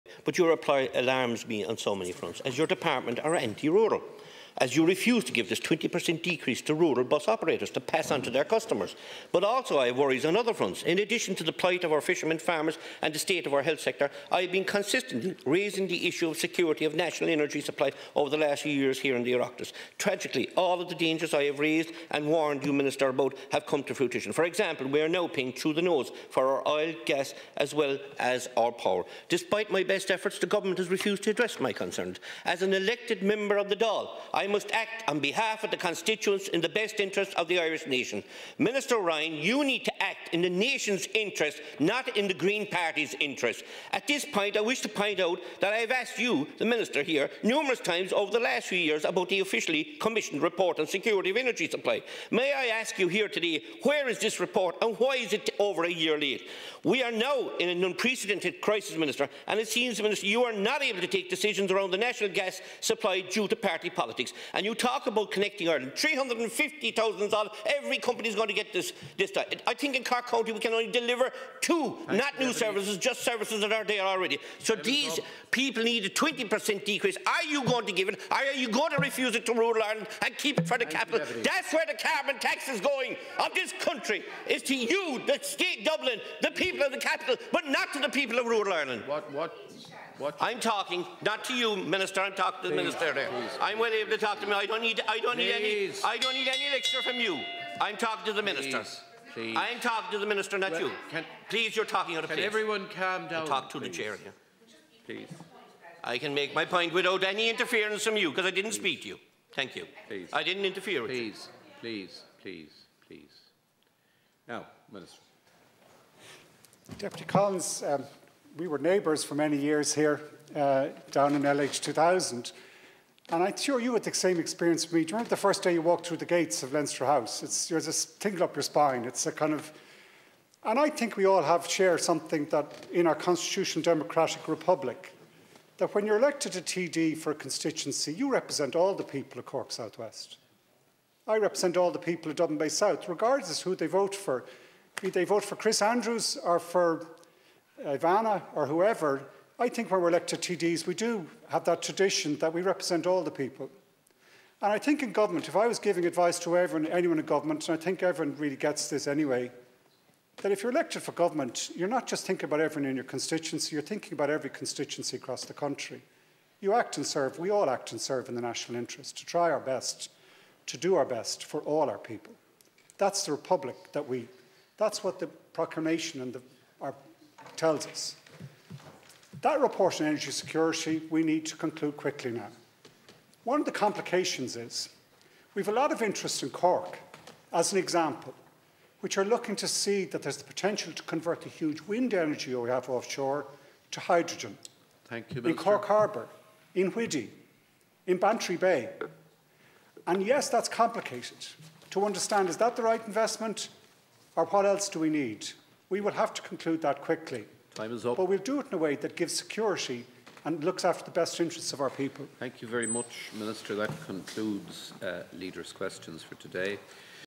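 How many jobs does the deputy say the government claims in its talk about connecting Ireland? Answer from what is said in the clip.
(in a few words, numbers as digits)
350,000.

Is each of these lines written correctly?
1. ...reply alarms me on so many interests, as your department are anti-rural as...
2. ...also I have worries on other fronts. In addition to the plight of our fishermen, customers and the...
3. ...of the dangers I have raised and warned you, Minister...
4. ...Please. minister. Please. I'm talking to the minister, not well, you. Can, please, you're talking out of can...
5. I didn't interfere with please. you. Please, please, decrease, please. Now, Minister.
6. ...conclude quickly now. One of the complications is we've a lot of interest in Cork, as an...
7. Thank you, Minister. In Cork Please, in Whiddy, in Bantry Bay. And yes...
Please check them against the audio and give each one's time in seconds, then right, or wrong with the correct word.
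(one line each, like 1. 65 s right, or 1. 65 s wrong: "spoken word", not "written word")
1. 0 s wrong: "fronts", not "interests"
2. 9 s wrong: "farmers", not "customers"
3. 20 s right
4. 98 s right
5. 110 s wrong: "please", not "decrease"
6. 181 s right
7. 195 s wrong: "Harbour", not "Please".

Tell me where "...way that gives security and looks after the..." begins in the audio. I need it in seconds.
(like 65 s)
208 s.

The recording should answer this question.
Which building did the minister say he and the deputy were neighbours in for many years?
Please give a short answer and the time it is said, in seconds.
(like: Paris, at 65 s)
LH 2000, at 121 s.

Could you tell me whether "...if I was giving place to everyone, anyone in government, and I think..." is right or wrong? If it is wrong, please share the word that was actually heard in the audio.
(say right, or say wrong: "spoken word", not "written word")
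wrong: "advice", not "place".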